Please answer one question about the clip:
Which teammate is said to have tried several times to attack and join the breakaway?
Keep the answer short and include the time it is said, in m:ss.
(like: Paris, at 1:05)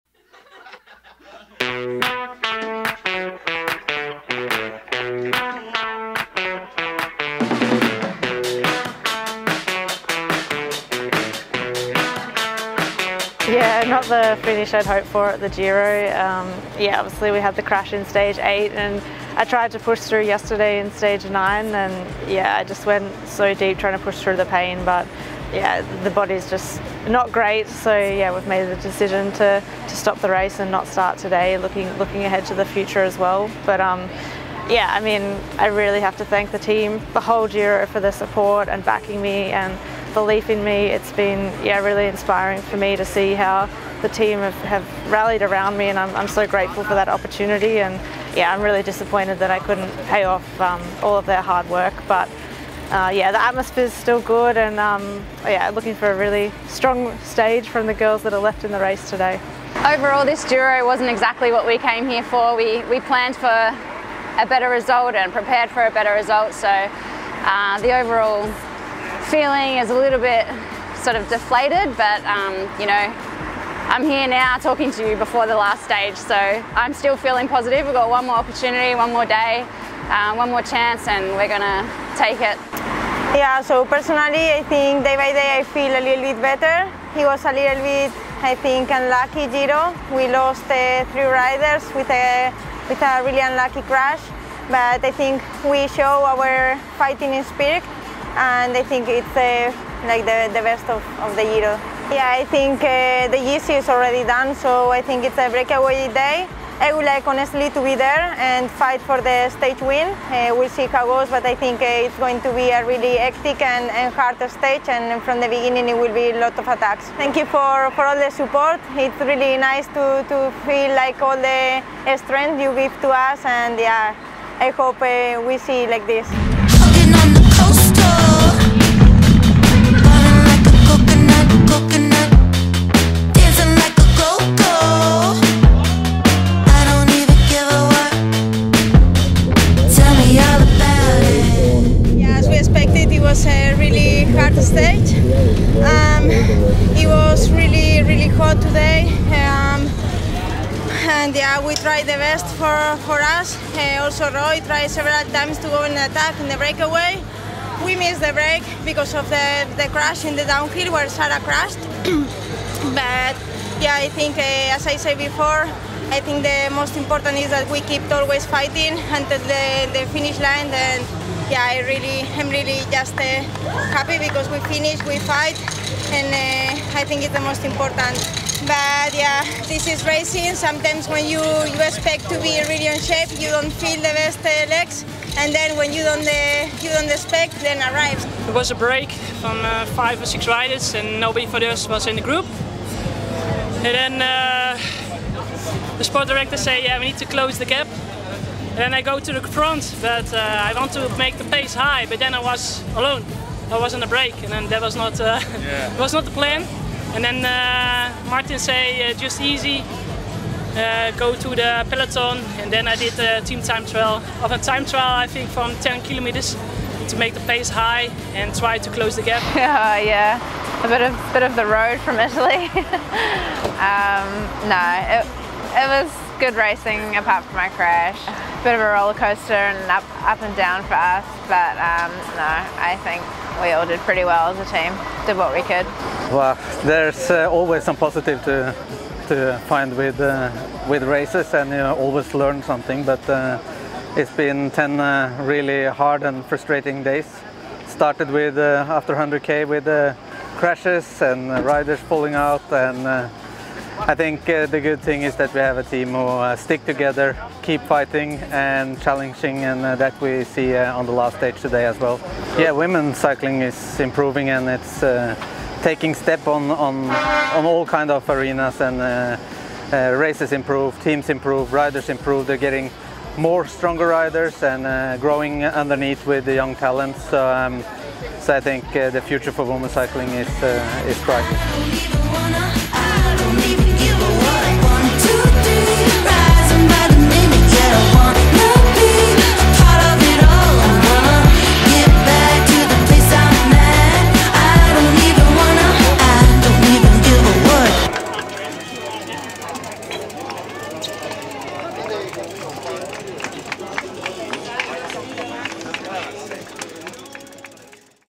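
Roy, at 2:34.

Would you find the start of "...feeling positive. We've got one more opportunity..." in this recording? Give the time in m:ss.
1:17.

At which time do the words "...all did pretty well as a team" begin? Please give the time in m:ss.
3:53.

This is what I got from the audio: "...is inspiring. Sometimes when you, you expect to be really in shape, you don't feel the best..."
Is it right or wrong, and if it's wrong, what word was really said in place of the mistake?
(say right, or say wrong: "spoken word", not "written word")
wrong: "racing", not "inspiring".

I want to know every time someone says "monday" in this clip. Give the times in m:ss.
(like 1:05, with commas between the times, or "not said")
not said.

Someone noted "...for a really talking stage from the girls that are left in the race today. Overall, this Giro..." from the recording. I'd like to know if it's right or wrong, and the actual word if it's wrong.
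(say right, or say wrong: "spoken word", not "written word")
wrong: "strong", not "talking".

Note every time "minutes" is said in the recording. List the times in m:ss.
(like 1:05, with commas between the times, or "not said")
not said.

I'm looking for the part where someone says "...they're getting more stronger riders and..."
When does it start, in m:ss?
4:32.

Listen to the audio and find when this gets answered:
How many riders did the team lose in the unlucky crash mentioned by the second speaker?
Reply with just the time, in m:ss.
1:31.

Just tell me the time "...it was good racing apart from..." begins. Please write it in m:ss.
3:45.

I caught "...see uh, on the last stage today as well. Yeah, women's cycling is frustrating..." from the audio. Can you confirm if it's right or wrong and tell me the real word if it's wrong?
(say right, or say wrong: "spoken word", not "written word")
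wrong: "improving", not "frustrating".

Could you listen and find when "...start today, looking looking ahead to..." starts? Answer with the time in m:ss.
0:30.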